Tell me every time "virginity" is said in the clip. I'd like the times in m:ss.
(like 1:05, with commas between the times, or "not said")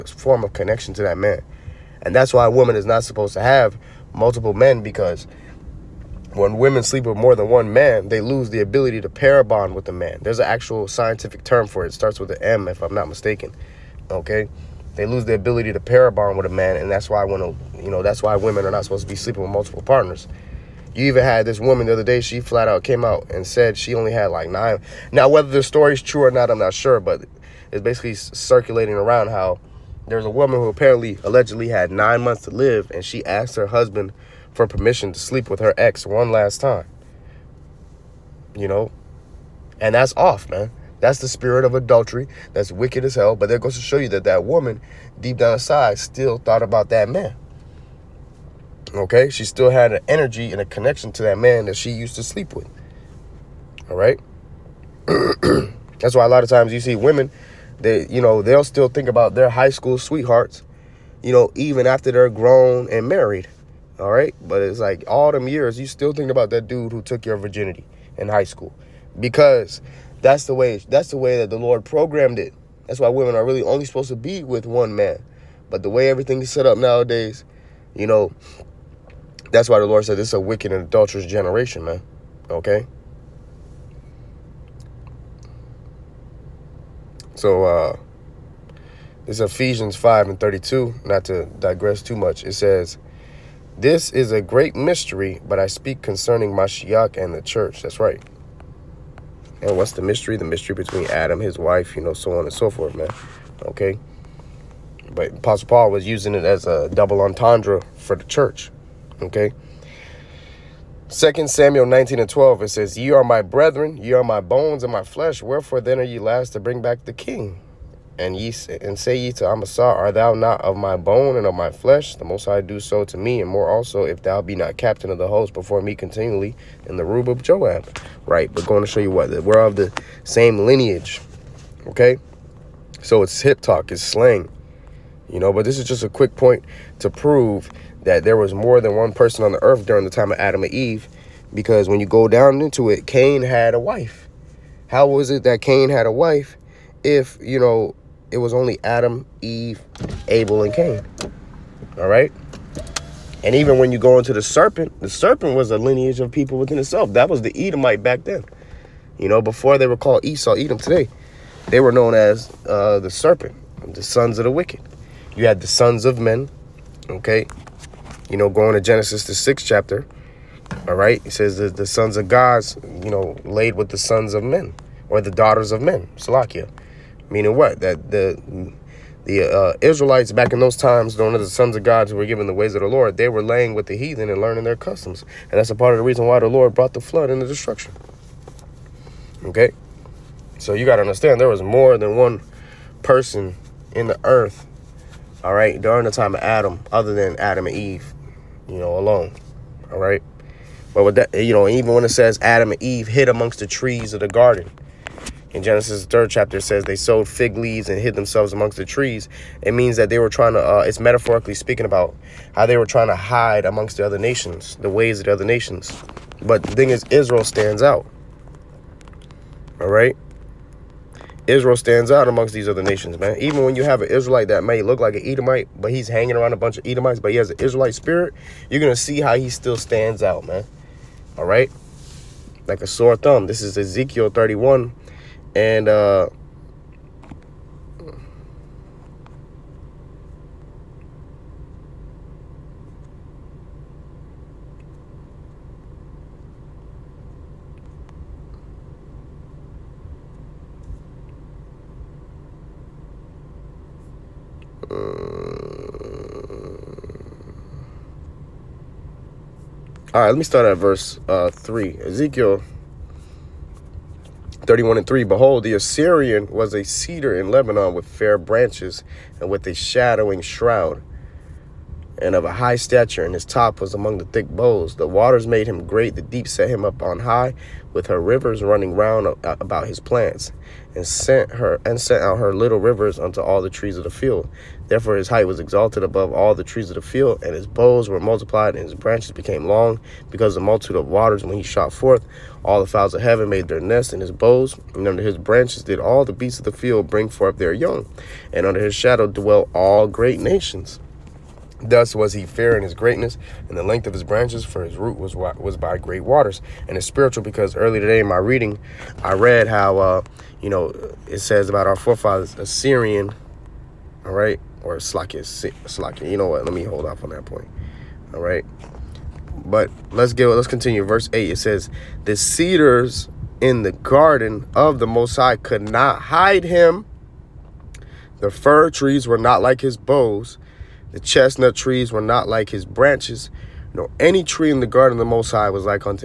1:07.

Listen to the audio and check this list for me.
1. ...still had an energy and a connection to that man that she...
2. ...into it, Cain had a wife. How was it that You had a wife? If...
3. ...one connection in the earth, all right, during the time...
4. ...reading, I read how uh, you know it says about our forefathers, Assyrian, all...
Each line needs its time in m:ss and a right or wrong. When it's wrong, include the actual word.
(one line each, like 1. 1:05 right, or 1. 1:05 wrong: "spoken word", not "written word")
1. 0:49 right
2. 2:22 wrong: "Cain", not "You"
3. 3:12 wrong: "person", not "connection"
4. 5:08 right.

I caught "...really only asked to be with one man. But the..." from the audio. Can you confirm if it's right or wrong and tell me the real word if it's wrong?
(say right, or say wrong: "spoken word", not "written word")
wrong: "supposed", not "asked".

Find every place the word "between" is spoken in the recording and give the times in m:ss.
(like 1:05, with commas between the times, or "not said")
1:40.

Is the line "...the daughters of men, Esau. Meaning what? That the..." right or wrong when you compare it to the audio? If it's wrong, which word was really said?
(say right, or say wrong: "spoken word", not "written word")
wrong: "Salakia", not "Esau".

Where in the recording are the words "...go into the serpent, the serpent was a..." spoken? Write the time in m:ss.
2:33.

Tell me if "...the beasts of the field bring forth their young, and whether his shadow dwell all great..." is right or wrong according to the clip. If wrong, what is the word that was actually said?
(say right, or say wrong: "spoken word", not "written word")
wrong: "under", not "whether".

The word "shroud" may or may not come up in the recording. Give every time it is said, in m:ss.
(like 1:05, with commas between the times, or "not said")
4:30.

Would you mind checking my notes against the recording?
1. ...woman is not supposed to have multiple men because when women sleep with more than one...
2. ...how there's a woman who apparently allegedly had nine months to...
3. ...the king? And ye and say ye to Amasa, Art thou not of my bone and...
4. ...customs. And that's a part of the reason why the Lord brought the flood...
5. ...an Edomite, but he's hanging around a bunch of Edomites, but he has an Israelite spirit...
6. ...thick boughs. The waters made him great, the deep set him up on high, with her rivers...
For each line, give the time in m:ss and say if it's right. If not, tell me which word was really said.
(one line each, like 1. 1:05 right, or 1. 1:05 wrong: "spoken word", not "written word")
1. 0:02 right
2. 0:29 right
3. 1:57 right
4. 3:04 right
5. 3:45 right
6. 4:34 right.